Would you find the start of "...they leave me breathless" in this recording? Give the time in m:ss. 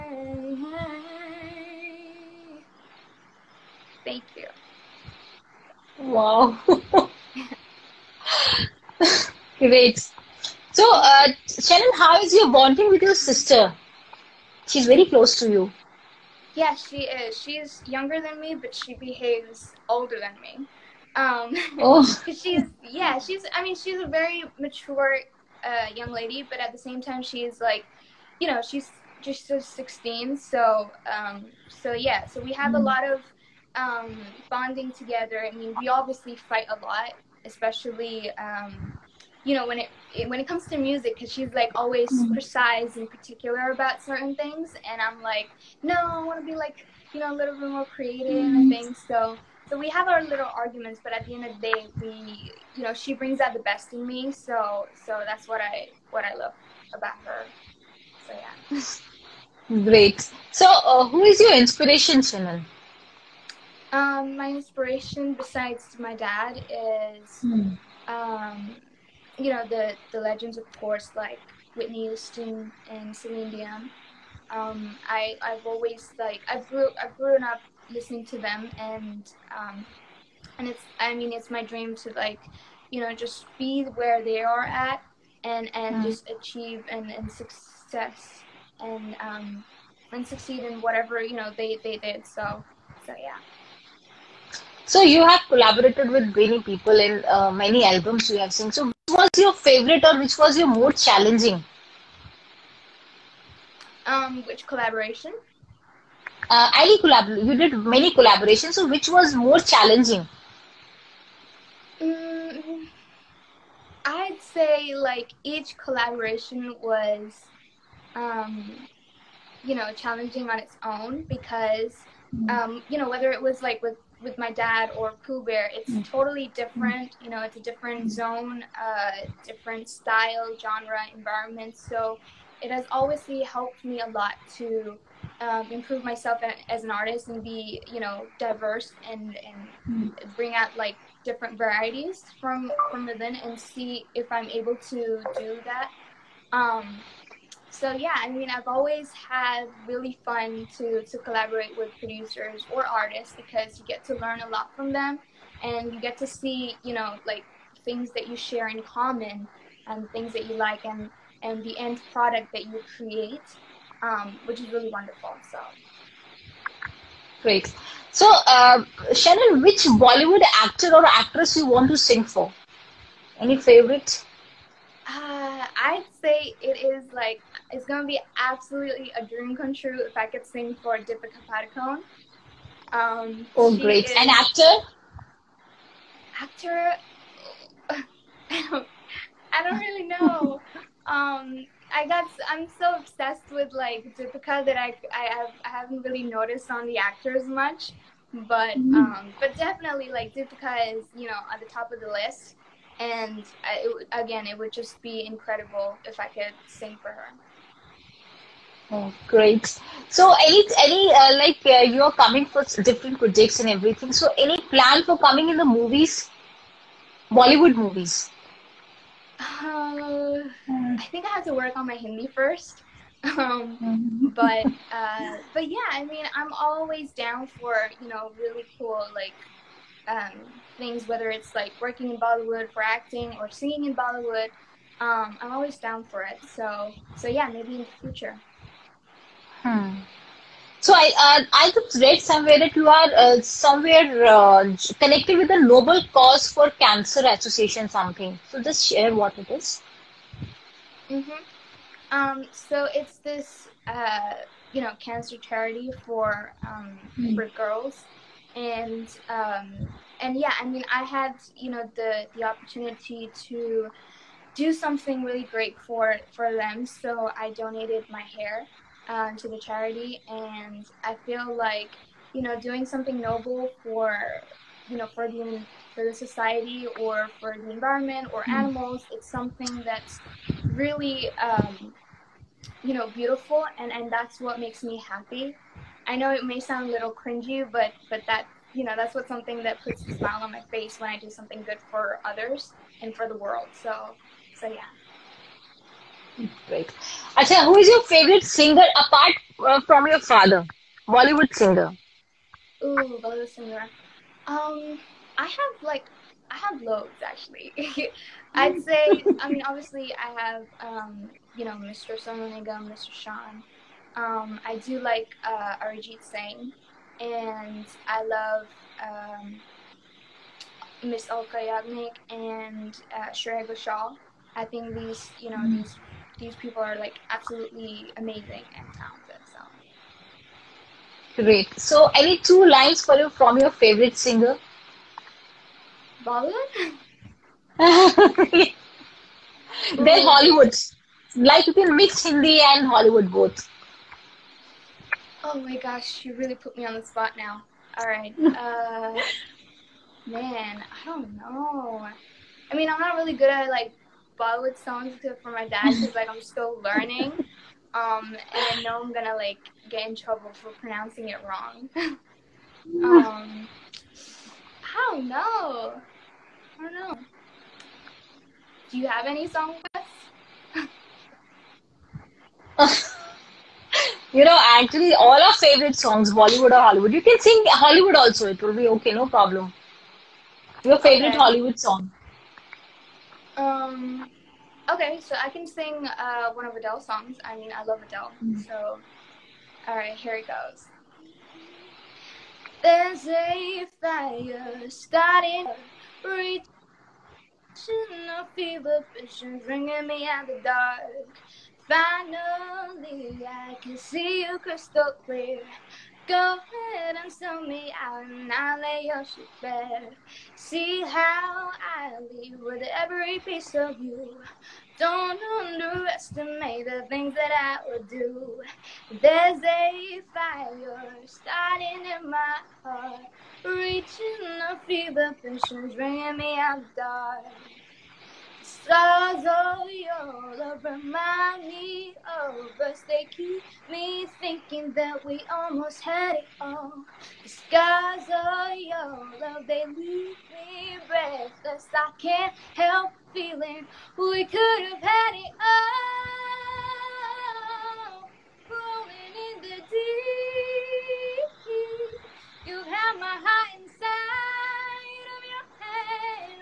7:19.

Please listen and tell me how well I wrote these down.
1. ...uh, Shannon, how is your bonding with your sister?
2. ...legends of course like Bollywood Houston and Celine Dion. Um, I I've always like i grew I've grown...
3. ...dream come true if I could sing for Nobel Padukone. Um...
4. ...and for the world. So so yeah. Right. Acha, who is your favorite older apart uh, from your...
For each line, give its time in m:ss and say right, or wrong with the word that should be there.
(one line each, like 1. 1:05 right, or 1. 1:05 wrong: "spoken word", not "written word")
1. 0:10 right
2. 1:10 wrong: "Whitney", not "Bollywood"
3. 2:59 wrong: "Deepika", not "Nobel"
4. 4:53 wrong: "singer", not "older".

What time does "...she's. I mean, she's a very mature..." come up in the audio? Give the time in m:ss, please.
0:23.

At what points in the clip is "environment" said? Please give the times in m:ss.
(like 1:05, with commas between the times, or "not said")
2:11, 4:37.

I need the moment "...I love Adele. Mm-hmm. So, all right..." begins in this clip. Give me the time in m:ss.
6:27.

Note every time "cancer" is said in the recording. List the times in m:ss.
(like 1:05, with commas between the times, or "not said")
4:06, 4:15.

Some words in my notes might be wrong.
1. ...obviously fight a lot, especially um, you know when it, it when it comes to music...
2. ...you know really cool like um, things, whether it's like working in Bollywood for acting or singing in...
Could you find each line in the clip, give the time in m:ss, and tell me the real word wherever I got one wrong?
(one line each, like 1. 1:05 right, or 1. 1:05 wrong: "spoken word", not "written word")
1. 0:35 right
2. 3:48 right.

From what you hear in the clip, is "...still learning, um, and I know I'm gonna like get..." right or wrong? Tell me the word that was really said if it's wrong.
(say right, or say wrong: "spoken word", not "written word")
right.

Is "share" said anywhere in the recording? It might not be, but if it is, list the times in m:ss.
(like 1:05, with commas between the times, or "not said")
2:38, 4:08.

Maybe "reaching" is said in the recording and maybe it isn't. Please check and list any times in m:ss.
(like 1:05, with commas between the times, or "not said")
6:36, 7:03.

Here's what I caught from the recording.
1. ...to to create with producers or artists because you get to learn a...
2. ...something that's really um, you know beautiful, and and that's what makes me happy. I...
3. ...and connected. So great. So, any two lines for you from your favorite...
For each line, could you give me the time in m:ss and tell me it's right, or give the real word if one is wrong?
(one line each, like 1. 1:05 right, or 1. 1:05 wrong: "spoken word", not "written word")
1. 2:30 wrong: "collaborate", not "create"
2. 4:39 right
3. 5:28 wrong: "talented", not "connected".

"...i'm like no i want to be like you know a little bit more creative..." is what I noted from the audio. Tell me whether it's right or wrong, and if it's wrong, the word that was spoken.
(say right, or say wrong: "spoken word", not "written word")
right.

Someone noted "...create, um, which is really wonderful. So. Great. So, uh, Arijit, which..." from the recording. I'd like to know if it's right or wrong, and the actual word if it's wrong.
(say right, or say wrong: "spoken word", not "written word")
wrong: "Shannon", not "Arijit".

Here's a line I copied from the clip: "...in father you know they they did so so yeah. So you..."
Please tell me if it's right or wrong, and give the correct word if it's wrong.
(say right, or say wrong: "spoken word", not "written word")
wrong: "whatever", not "father".